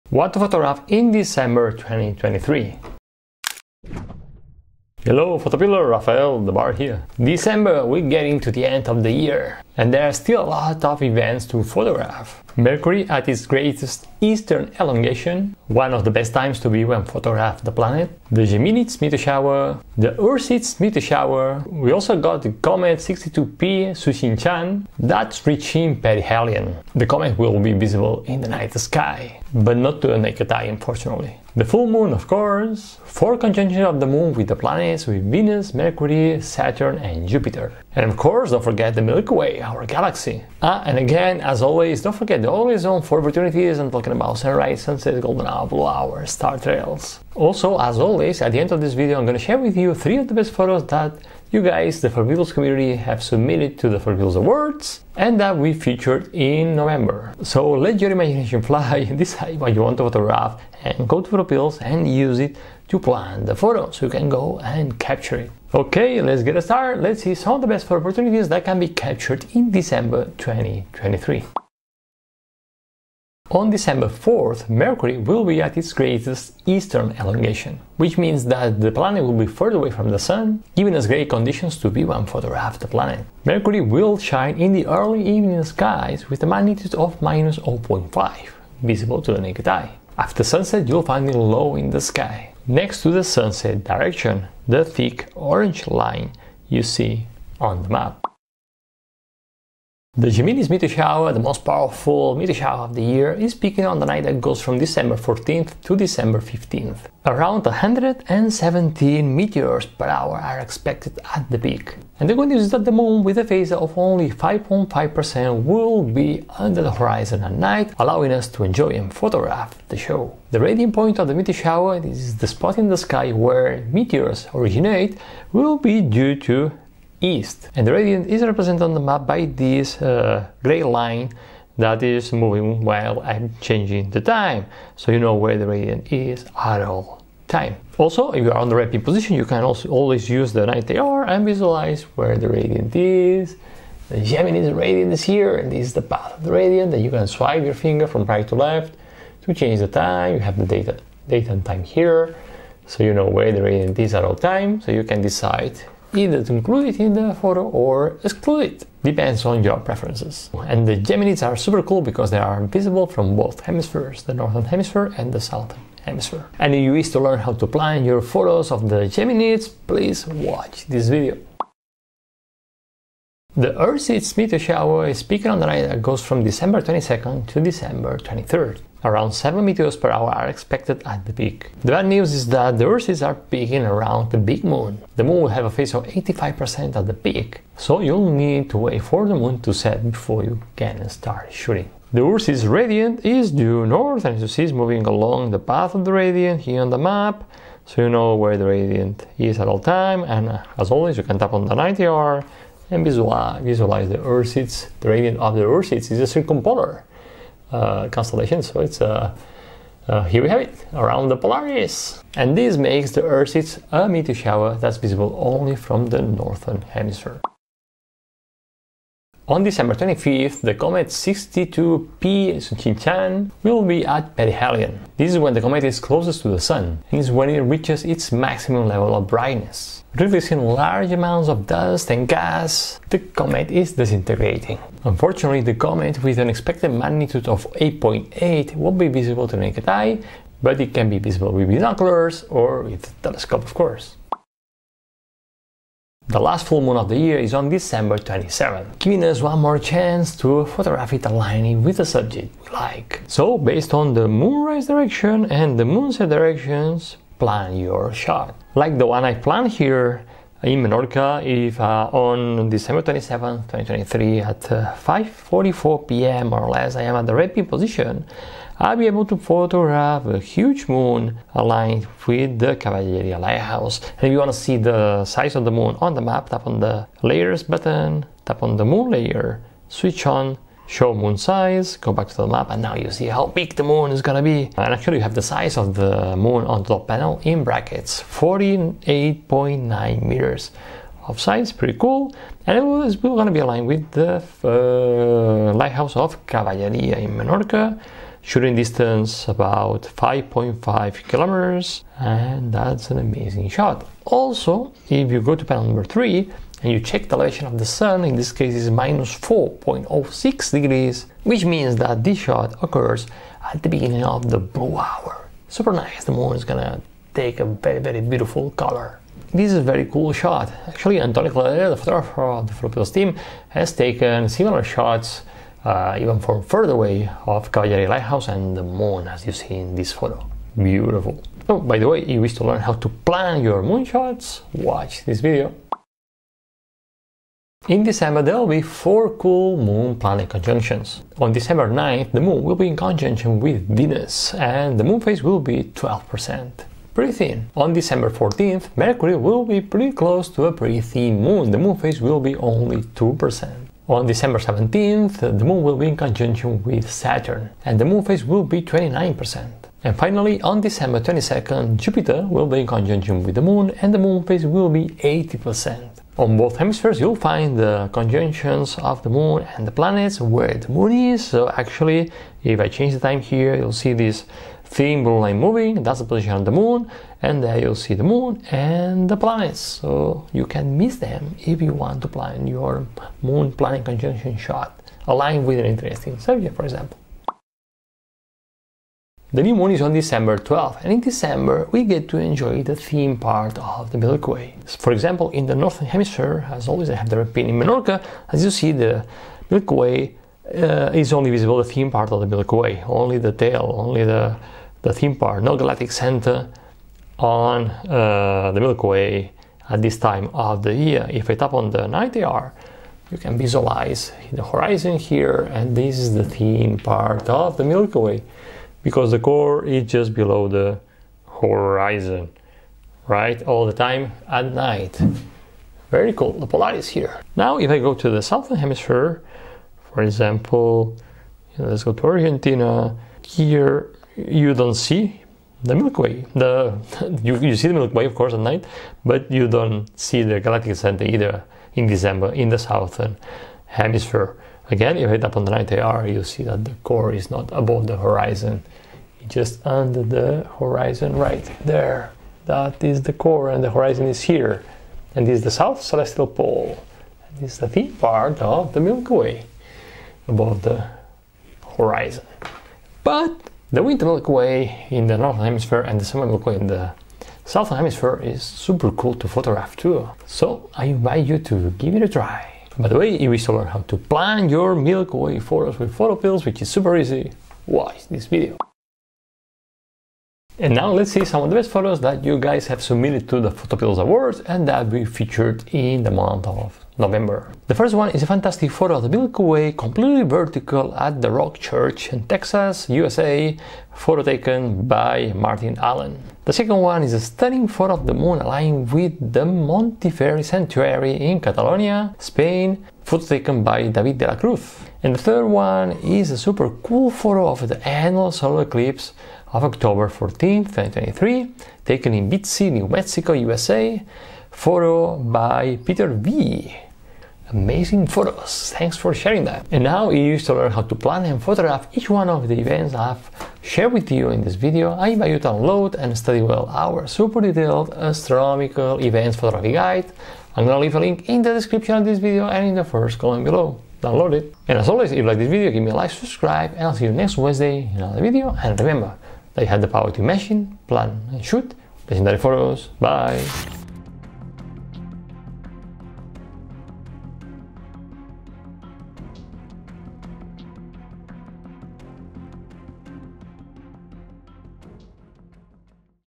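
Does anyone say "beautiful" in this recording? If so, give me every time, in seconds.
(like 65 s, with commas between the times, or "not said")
318 s, 330 s.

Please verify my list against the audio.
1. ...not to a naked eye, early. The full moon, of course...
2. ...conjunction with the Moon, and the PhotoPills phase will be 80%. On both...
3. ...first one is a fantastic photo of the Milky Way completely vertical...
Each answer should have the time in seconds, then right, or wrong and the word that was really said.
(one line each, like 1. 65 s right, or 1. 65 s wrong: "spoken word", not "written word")
1. 29 s wrong: "unfortunately", not "early"
2. 362 s wrong: "Moon", not "PhotoPills"
3. 487 s right.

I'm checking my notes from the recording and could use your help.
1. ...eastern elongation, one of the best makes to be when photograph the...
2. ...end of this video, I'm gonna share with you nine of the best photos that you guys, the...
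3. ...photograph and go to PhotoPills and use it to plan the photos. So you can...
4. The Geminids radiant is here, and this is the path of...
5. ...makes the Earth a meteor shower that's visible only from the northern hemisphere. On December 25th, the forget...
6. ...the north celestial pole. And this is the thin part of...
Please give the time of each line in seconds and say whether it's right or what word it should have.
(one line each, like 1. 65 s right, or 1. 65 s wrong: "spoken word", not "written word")
1. 14 s wrong: "times", not "makes"
2. 48 s wrong: "three", not "nine"
3. 60 s right
4. 144 s right
5. 212 s wrong: "comet", not "forget"
6. 455 s wrong: "south", not "north".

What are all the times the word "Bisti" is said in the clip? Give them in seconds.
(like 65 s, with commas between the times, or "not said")
512 s.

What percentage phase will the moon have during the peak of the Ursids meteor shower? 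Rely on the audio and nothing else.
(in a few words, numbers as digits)
85%.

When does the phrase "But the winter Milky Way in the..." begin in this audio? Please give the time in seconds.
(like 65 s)
463 s.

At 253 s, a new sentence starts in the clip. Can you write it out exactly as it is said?
So, based on the moonrise direction and the moonset directions, plan your shot.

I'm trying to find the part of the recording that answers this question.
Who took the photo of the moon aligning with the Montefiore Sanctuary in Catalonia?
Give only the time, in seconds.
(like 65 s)
504 s.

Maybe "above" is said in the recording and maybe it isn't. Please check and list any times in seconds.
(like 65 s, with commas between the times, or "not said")
447 s, 460 s.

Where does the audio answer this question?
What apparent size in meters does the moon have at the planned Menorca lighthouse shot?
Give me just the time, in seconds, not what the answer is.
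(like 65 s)
288 s.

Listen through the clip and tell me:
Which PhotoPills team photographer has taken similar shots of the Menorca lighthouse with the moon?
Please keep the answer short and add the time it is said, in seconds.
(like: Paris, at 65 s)
Antoni Cladera, at 321 s.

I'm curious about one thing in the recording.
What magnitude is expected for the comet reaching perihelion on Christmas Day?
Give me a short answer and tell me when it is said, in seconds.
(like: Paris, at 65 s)
8.8, at 237 s.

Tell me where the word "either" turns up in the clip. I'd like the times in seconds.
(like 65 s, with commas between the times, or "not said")
156 s, 441 s.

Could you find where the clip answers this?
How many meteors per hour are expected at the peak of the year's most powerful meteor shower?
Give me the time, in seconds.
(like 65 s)
107 s.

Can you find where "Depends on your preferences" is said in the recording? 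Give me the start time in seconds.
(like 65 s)
159 s.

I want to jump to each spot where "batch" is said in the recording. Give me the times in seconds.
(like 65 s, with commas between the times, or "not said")
not said.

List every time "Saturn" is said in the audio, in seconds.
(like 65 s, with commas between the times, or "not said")
36 s, 357 s.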